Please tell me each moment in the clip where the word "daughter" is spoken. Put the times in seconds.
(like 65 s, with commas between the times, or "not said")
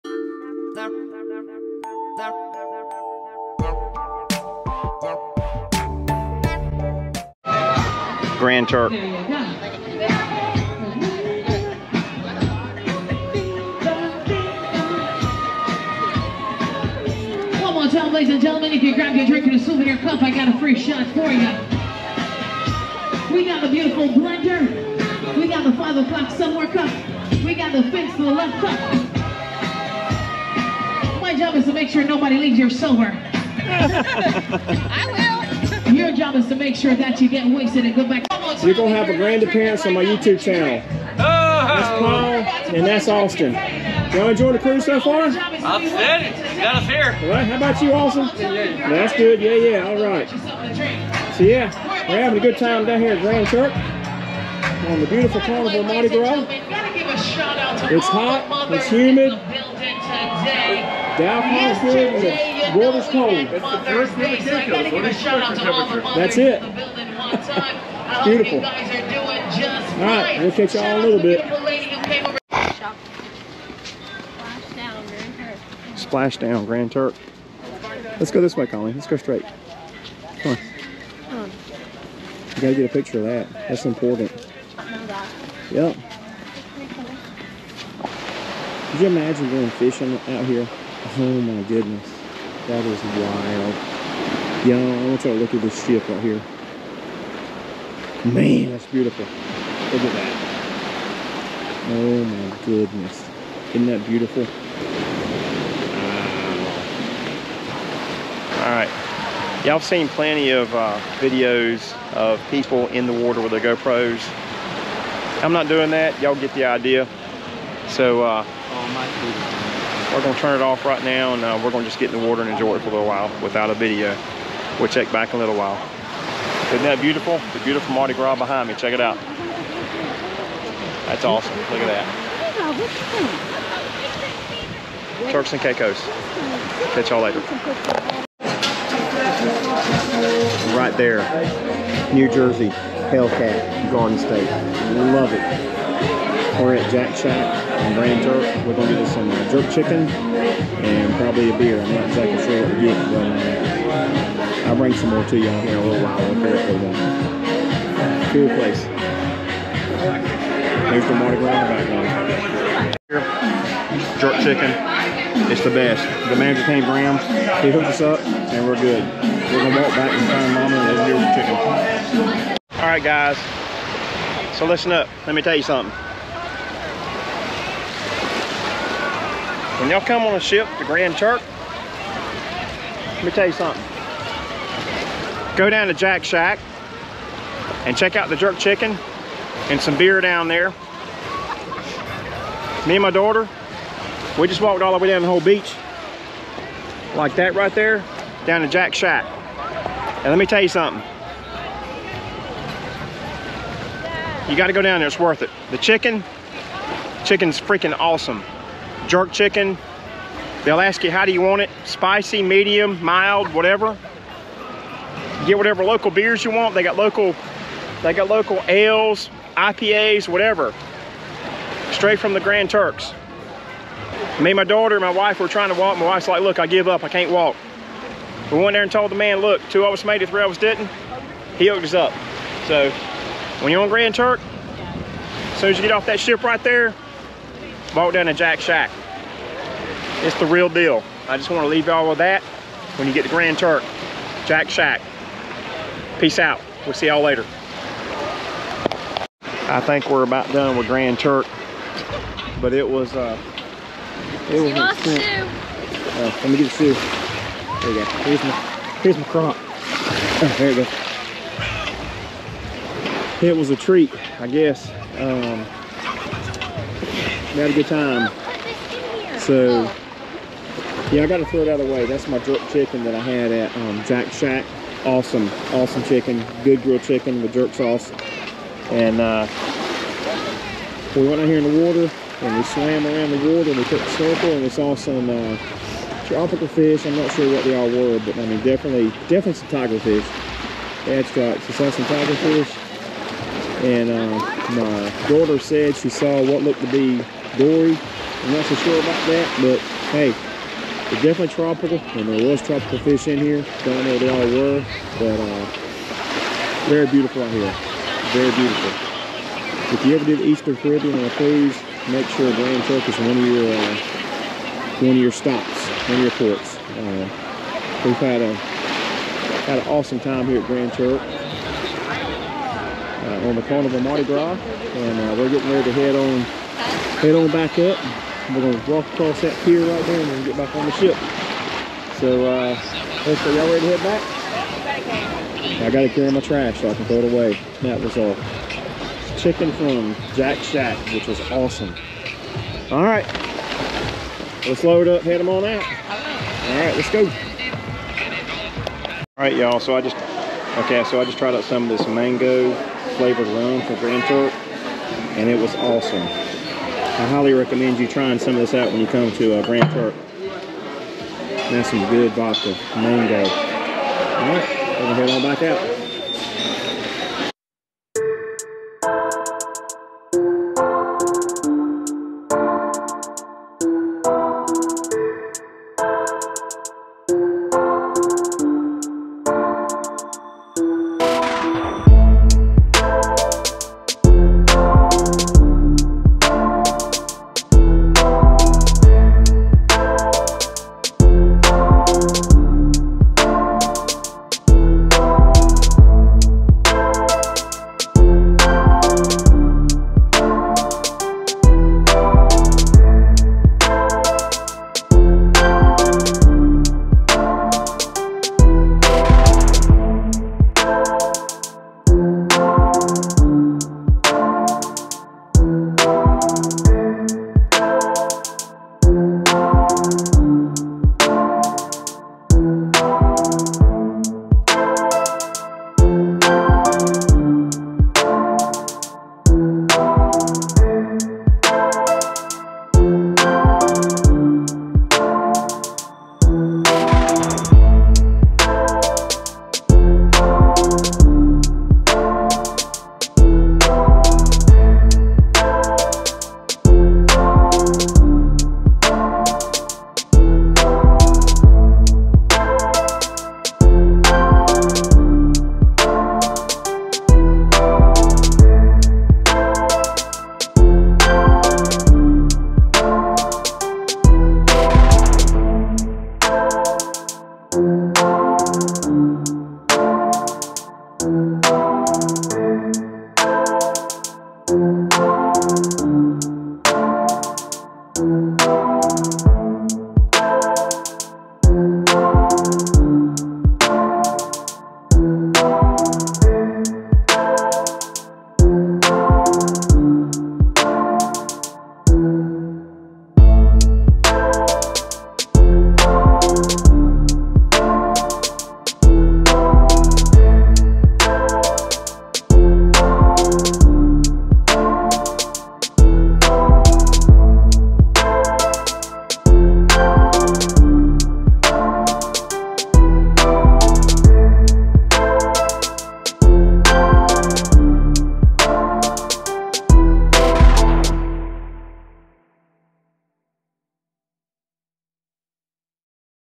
193 s, 224 s, 295 s.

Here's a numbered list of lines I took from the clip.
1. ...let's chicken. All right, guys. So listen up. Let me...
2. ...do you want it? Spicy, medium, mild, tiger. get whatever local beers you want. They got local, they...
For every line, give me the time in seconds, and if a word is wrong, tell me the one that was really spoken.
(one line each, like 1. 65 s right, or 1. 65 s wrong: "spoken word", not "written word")
1. 171 s right
2. 211 s wrong: "whatever", not "tiger".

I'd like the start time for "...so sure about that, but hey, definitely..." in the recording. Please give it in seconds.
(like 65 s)
298 s.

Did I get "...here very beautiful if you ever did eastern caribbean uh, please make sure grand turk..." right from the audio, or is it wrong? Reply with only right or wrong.
right.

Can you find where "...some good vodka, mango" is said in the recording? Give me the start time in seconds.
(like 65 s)
361 s.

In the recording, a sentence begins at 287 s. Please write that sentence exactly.
I'm not sure what they all were, but I mean, definitely, definitely some tiger fish.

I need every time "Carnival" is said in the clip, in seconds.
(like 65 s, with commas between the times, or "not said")
55 s, 323 s.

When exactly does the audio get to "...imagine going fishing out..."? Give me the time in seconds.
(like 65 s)
89 s.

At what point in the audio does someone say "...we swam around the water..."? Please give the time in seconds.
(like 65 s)
282 s.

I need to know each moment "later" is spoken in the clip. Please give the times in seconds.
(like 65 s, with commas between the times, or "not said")
137 s, 247 s.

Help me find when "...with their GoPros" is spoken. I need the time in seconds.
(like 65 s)
113 s.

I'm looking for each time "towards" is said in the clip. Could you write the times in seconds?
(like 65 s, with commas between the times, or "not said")
not said.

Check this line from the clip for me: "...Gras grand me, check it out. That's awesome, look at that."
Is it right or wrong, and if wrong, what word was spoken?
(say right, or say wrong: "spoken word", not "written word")
wrong: "behind", not "grand".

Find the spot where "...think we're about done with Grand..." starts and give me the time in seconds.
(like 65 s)
249 s.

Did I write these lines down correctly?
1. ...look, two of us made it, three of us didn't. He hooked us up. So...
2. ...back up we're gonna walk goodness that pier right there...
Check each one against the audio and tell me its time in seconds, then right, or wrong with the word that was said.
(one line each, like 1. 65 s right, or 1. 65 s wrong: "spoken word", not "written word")
1. 229 s right
2. 327 s wrong: "across", not "goodness".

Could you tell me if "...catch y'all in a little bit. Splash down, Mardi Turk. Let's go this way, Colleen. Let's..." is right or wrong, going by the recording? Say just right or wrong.
wrong.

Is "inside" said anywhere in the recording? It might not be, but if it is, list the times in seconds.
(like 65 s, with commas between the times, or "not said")
not said.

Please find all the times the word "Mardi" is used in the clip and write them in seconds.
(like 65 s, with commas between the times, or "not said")
55 s, 127 s, 161 s, 323 s.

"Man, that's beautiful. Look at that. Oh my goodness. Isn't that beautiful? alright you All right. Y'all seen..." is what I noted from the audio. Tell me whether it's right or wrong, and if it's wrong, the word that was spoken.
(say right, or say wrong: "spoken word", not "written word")
right.